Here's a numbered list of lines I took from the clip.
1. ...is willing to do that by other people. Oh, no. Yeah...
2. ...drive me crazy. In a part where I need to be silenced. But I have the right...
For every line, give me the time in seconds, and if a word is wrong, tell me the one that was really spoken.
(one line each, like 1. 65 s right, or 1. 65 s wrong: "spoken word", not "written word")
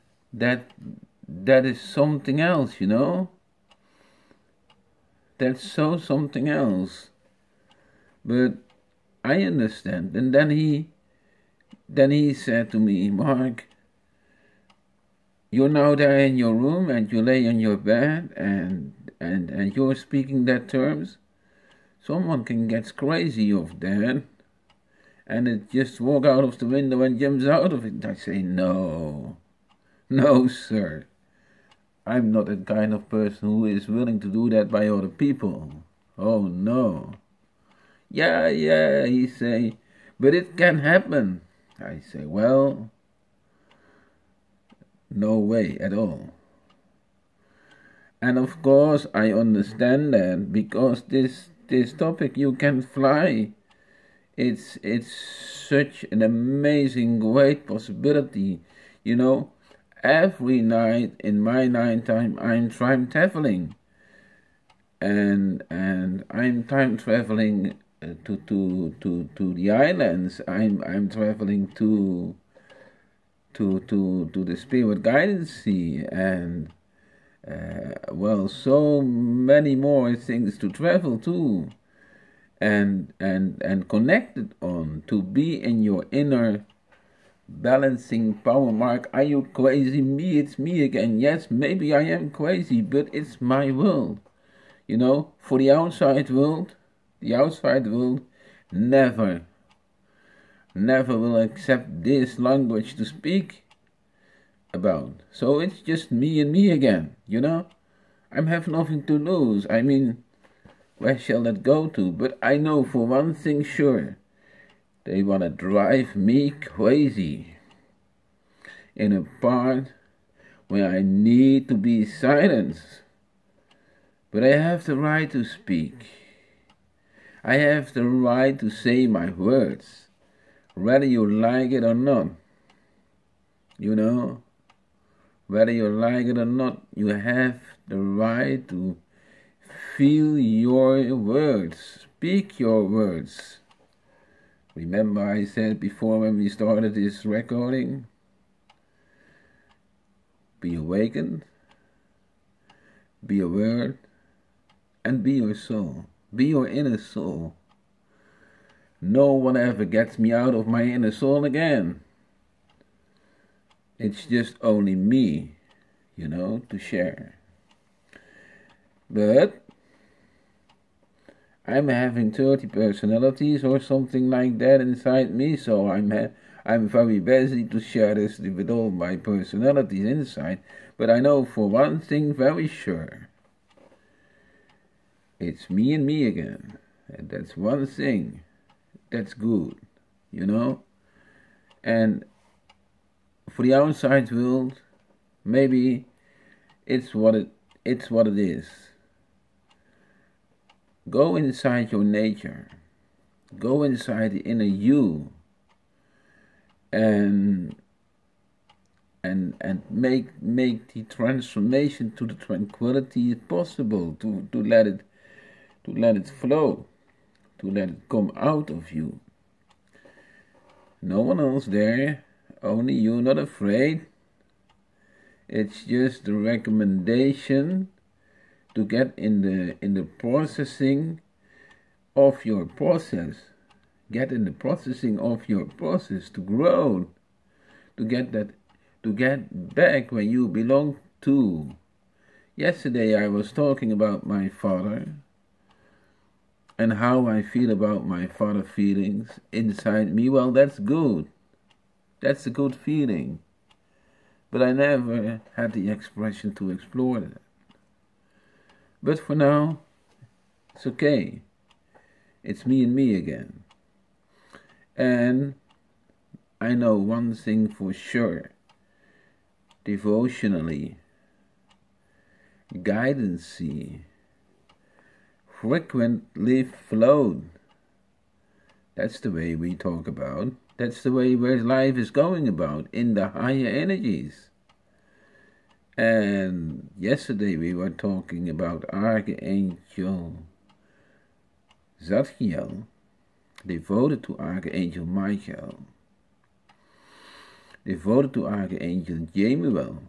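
1. 33 s right
2. 115 s right.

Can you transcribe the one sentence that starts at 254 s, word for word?
But I never had the expression to explore that.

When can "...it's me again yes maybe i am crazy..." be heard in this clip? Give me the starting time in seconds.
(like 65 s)
90 s.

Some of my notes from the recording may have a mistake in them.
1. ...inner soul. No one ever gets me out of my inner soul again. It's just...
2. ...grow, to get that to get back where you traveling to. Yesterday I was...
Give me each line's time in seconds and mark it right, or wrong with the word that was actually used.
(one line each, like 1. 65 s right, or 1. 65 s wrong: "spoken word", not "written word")
1. 156 s right
2. 236 s wrong: "belong", not "traveling".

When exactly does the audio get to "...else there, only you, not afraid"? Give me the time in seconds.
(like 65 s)
221 s.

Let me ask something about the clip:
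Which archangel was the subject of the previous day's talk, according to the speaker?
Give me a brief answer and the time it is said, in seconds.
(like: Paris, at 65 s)
Archangel Zadkiel, at 288 s.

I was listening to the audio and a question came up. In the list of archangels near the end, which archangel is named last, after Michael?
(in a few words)
Archangel Chamuel.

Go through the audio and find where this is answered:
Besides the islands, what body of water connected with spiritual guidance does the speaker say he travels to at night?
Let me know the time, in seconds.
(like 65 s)
74 s.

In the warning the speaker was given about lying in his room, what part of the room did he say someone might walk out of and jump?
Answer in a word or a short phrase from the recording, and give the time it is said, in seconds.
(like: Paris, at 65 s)
The window, at 26 s.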